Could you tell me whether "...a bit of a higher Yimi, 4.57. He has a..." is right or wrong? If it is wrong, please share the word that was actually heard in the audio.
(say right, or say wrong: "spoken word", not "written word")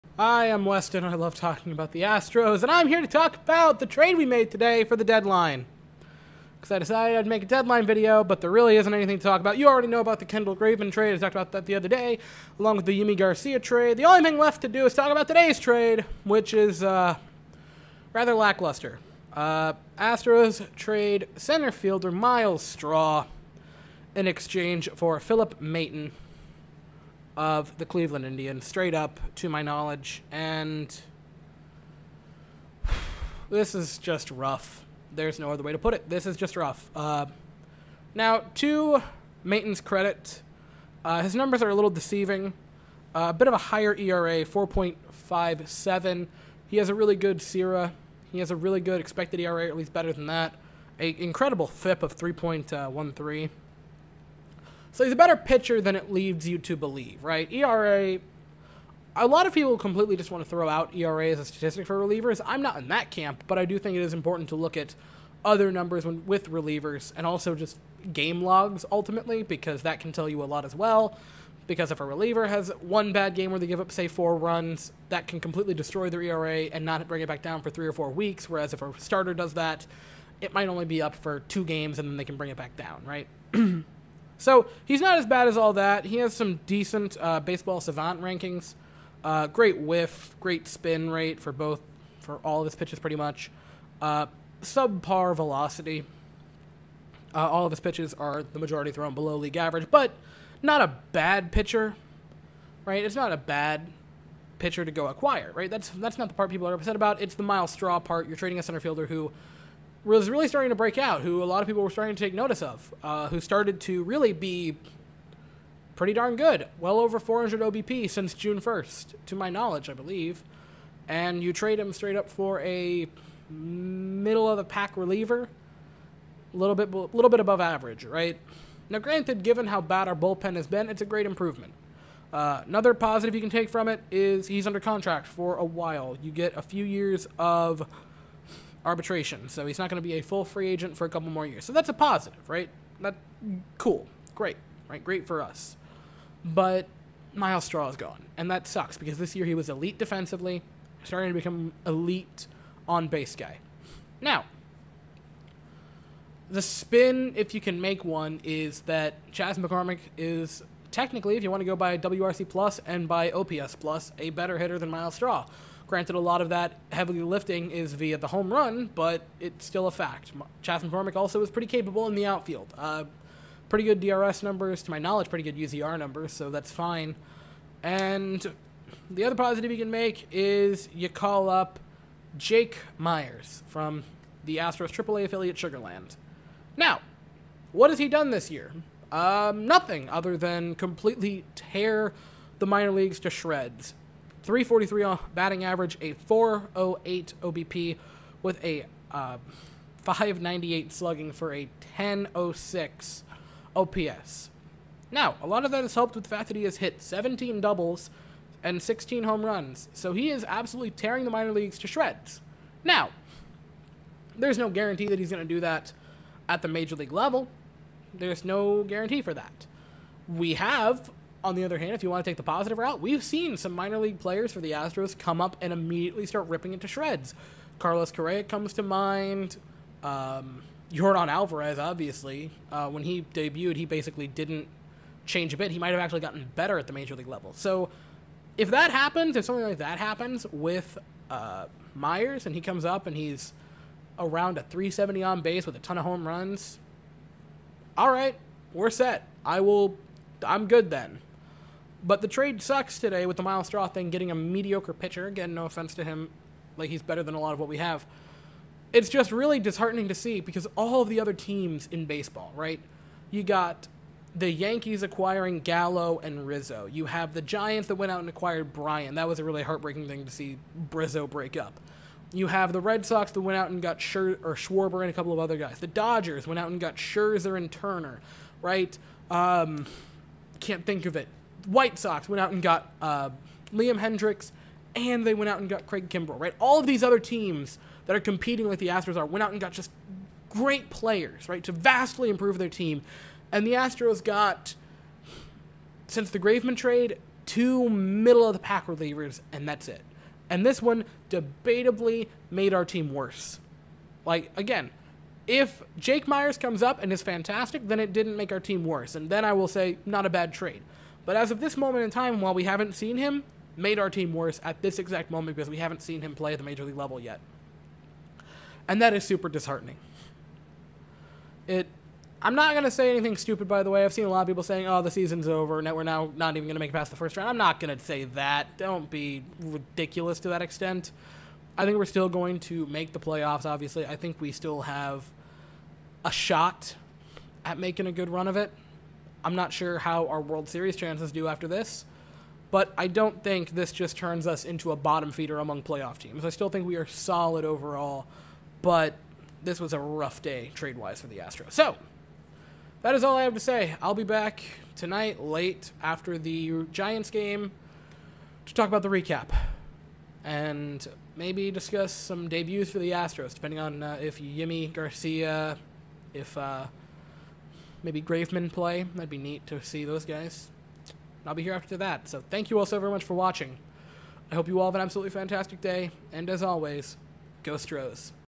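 wrong: "ERA", not "Yimi".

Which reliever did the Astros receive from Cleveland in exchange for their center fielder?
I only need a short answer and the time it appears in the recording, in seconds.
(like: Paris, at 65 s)
Philip Maton, at 25 s.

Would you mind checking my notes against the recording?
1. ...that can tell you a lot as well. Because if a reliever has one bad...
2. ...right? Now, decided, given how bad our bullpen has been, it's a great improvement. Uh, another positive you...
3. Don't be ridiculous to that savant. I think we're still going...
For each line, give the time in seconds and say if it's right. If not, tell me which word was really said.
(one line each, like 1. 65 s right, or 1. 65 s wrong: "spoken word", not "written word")
1. 69 s right
2. 128 s wrong: "granted", not "decided"
3. 328 s wrong: "extent", not "savant".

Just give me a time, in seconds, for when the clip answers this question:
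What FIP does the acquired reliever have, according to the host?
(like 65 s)
52 s.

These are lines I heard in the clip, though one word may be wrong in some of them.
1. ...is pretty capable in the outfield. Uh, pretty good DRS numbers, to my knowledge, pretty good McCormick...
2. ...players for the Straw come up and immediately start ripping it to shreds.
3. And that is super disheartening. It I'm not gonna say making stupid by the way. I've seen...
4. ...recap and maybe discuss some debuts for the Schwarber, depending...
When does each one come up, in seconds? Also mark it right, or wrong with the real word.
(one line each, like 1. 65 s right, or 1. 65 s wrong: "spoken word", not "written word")
1. 171 s wrong: "UZR", not "McCormick"
2. 224 s wrong: "Astros", not "Straw"
3. 318 s wrong: "anything", not "making"
4. 359 s wrong: "Astros", not "Schwarber".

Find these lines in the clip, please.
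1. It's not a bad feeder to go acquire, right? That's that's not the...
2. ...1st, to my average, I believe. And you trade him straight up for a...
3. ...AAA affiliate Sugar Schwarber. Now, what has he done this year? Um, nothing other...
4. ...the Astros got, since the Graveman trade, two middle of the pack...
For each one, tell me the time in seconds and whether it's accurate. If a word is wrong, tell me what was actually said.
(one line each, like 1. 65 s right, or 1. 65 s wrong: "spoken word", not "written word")
1. 103 s wrong: "pitcher", not "feeder"
2. 118 s wrong: "knowledge", not "average"
3. 184 s wrong: "Land", not "Schwarber"
4. 293 s right.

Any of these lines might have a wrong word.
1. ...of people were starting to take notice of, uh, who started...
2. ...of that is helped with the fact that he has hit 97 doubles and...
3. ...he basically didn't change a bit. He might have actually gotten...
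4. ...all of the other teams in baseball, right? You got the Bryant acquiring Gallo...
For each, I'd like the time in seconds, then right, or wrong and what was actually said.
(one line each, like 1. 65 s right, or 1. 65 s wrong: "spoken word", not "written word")
1. 111 s right
2. 205 s wrong: "17", not "97"
3. 233 s right
4. 260 s wrong: "Yankees", not "Bryant".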